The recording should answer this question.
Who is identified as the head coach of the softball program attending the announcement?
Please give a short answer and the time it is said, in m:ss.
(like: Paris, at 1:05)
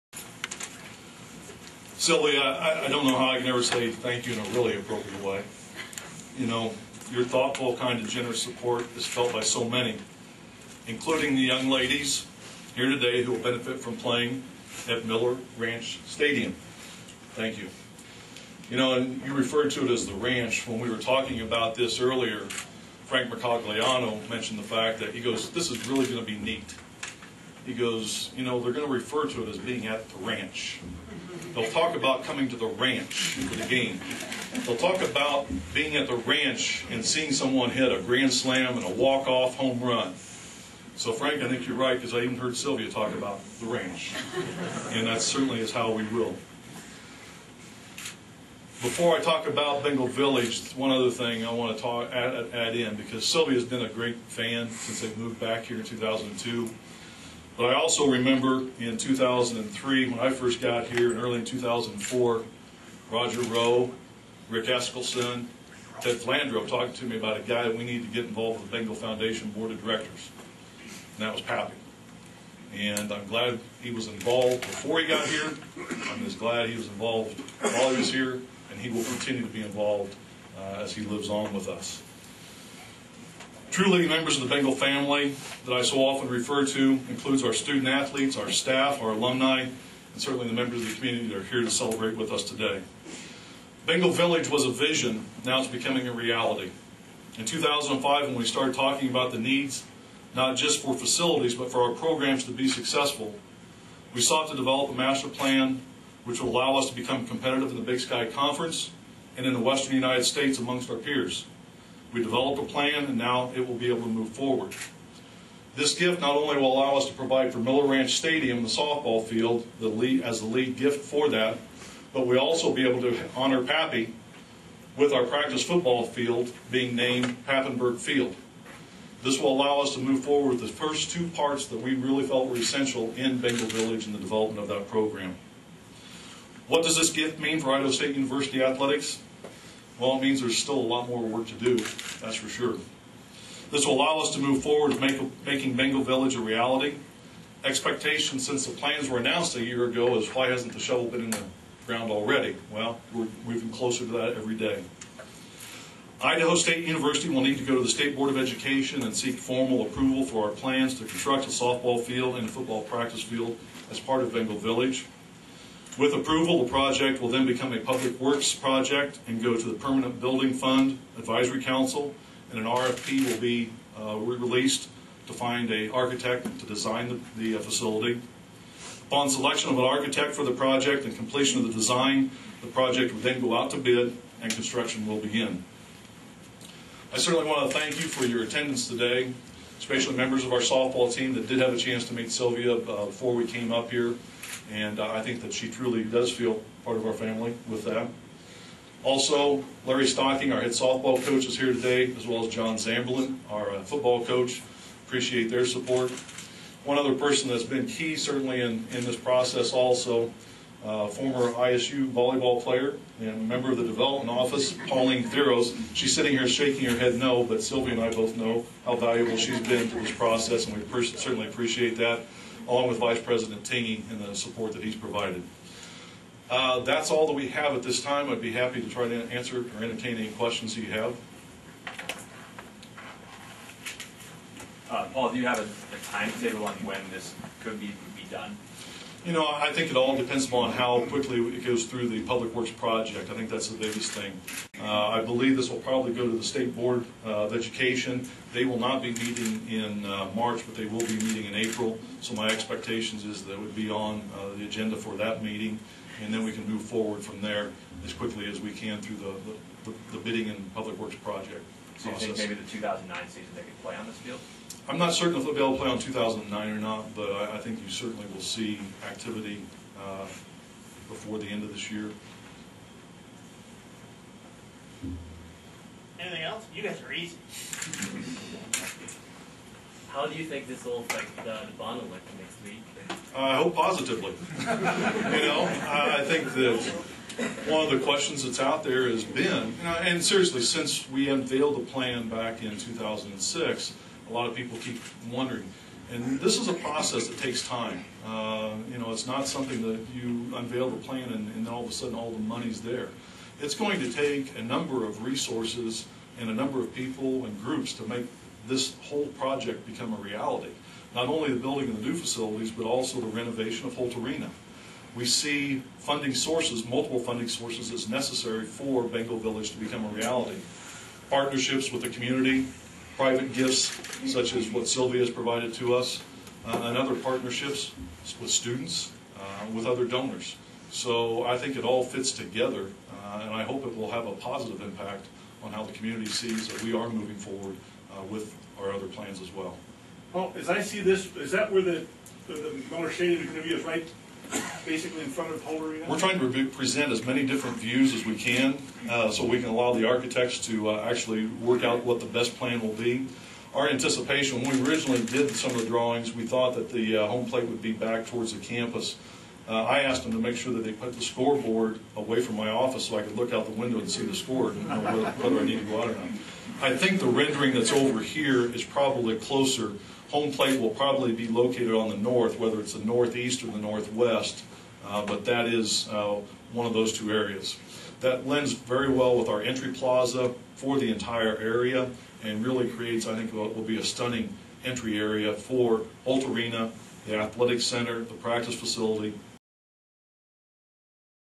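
Larry Stocking, at 3:19.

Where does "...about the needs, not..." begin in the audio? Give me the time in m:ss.
1:39.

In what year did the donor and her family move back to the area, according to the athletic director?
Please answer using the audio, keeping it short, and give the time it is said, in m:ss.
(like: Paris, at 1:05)
2002, at 0:55.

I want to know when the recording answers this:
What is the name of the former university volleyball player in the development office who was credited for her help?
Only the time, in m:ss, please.
3:34.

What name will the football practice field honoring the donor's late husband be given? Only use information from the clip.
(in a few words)
Papenberg Field.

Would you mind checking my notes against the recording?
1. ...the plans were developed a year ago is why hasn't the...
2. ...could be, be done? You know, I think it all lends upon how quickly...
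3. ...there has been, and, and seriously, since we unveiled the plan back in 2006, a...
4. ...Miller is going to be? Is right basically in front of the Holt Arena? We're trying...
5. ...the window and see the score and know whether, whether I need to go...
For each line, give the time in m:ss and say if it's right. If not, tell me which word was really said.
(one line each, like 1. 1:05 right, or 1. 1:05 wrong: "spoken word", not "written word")
1. 2:28 wrong: "announced", not "developed"
2. 3:57 wrong: "depends", not "lends"
3. 4:48 right
4. 5:42 right
5. 6:03 right.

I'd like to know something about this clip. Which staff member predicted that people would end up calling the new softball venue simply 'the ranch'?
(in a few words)
Frank Mercogliano.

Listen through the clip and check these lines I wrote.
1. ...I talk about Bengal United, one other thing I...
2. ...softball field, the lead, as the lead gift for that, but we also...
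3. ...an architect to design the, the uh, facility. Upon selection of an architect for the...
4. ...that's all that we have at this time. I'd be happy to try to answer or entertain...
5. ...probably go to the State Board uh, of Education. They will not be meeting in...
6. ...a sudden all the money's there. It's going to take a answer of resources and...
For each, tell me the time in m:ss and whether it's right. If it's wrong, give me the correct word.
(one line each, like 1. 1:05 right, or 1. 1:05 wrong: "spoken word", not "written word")
1. 0:49 wrong: "Village", not "United"
2. 1:58 right
3. 2:55 right
4. 3:46 right
5. 4:05 right
6. 5:01 wrong: "number", not "answer".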